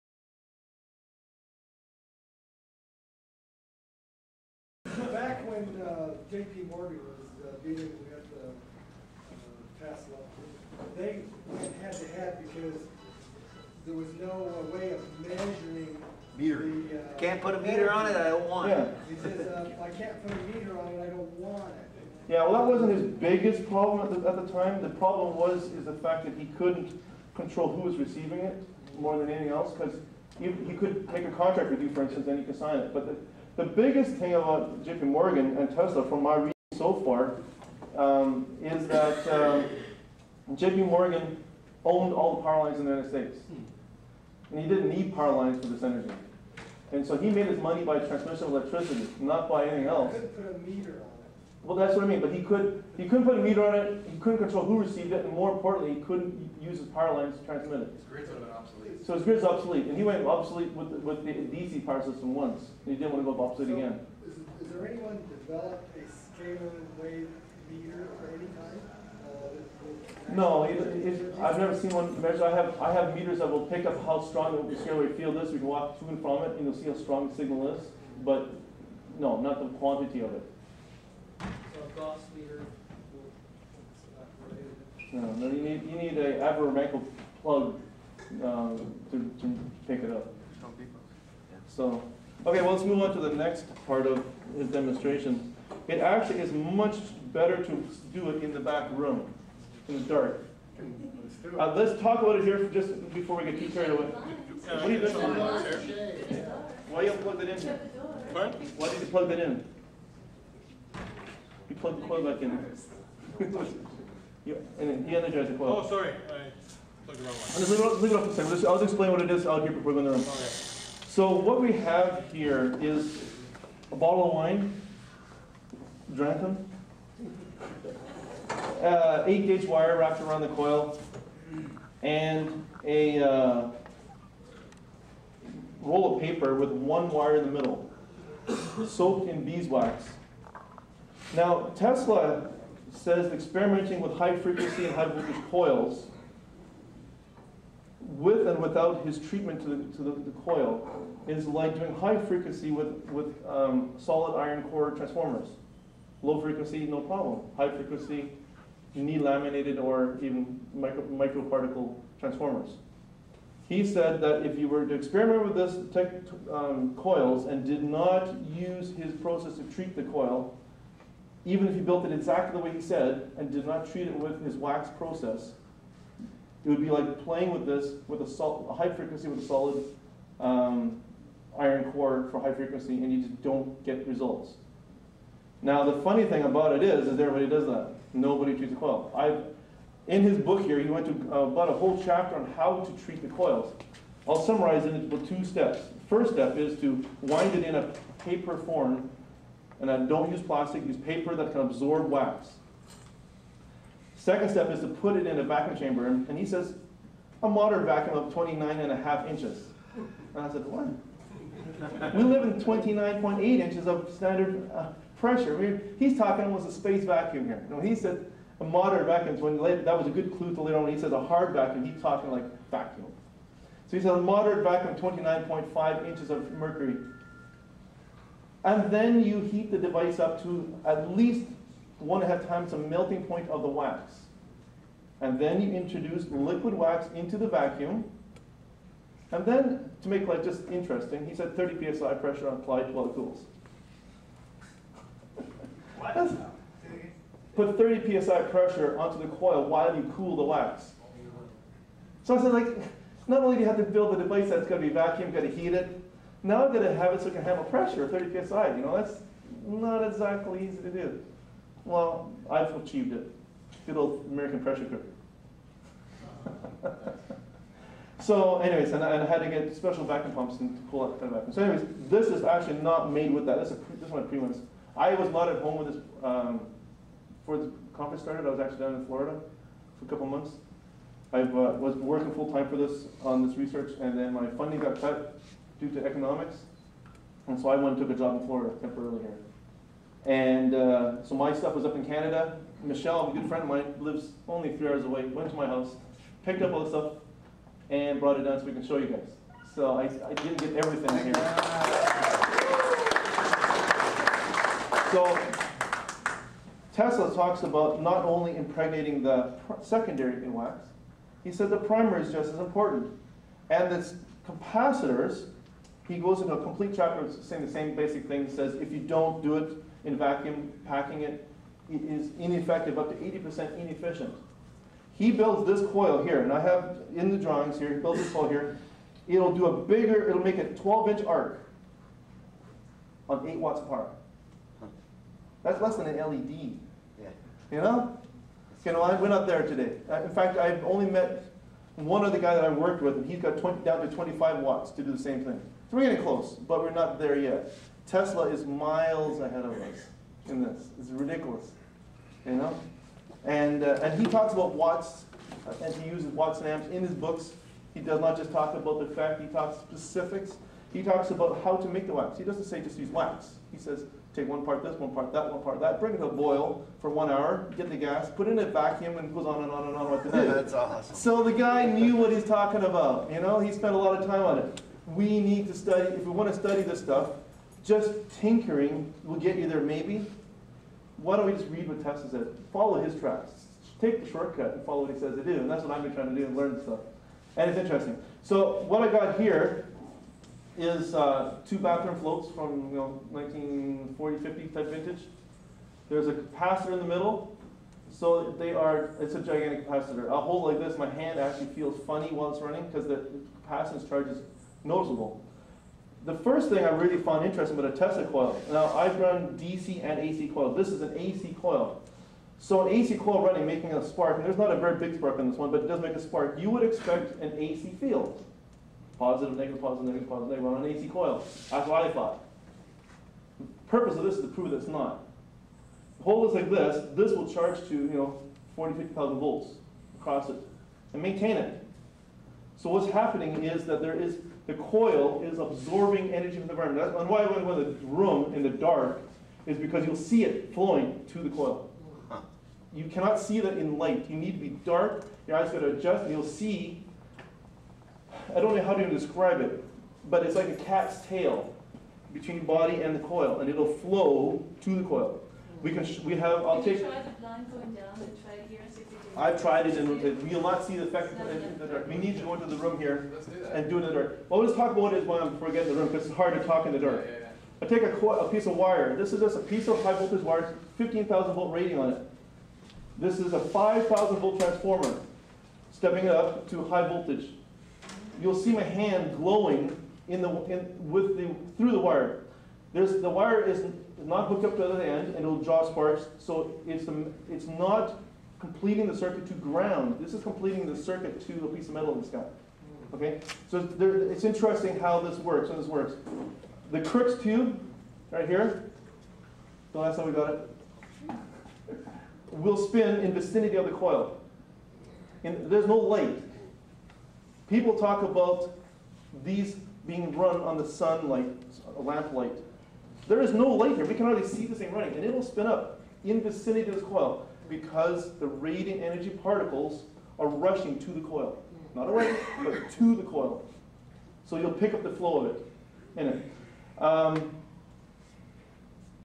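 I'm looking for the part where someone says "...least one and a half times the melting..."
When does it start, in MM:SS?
03:51.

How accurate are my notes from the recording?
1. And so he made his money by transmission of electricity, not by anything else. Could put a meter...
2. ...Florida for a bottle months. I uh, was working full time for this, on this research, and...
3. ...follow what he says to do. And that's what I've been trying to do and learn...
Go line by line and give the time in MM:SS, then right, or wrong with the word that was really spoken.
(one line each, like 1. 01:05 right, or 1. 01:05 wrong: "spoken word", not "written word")
1. 00:46 right
2. 04:39 wrong: "couple", not "bottle"
3. 06:24 right.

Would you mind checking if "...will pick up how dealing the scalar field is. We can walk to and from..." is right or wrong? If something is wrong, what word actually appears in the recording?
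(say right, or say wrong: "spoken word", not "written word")
wrong: "strong", not "dealing".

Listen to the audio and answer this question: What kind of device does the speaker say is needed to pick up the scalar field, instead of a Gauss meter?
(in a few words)
Avramenko plug.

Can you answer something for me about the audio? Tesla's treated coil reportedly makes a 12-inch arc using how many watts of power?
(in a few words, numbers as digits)
8 watts.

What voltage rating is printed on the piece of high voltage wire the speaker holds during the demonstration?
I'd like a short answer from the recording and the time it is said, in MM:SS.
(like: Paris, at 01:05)
15,000 volts, at 07:50.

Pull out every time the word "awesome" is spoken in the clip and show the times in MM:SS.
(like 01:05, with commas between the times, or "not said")
06:10.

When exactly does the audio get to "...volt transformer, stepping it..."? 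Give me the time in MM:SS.
07:54.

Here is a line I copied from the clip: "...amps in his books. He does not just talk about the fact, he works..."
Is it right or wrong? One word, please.
wrong.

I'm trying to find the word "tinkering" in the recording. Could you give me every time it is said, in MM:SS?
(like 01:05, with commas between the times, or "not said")
06:18.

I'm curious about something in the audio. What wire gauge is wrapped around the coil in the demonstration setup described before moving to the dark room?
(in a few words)
8 gauge.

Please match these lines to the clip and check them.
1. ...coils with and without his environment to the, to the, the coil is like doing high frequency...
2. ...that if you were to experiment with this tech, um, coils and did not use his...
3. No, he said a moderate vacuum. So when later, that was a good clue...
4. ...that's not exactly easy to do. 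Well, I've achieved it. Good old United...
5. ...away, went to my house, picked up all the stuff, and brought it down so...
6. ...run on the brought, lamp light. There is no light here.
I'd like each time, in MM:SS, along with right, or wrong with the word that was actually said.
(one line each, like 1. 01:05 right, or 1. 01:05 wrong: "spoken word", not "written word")
1. 02:25 wrong: "treatment", not "environment"
2. 02:44 right
3. 03:37 right
4. 04:18 wrong: "American", not "United"
5. 04:55 right
6. 08:30 wrong: "sunlight", not "brought".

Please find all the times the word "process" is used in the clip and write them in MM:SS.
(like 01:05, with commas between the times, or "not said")
02:49, 02:54.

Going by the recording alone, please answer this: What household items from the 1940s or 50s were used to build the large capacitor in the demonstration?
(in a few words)
Bathroom floats.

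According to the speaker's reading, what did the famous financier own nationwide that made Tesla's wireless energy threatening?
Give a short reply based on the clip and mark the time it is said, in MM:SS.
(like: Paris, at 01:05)
All the power lines, at 00:42.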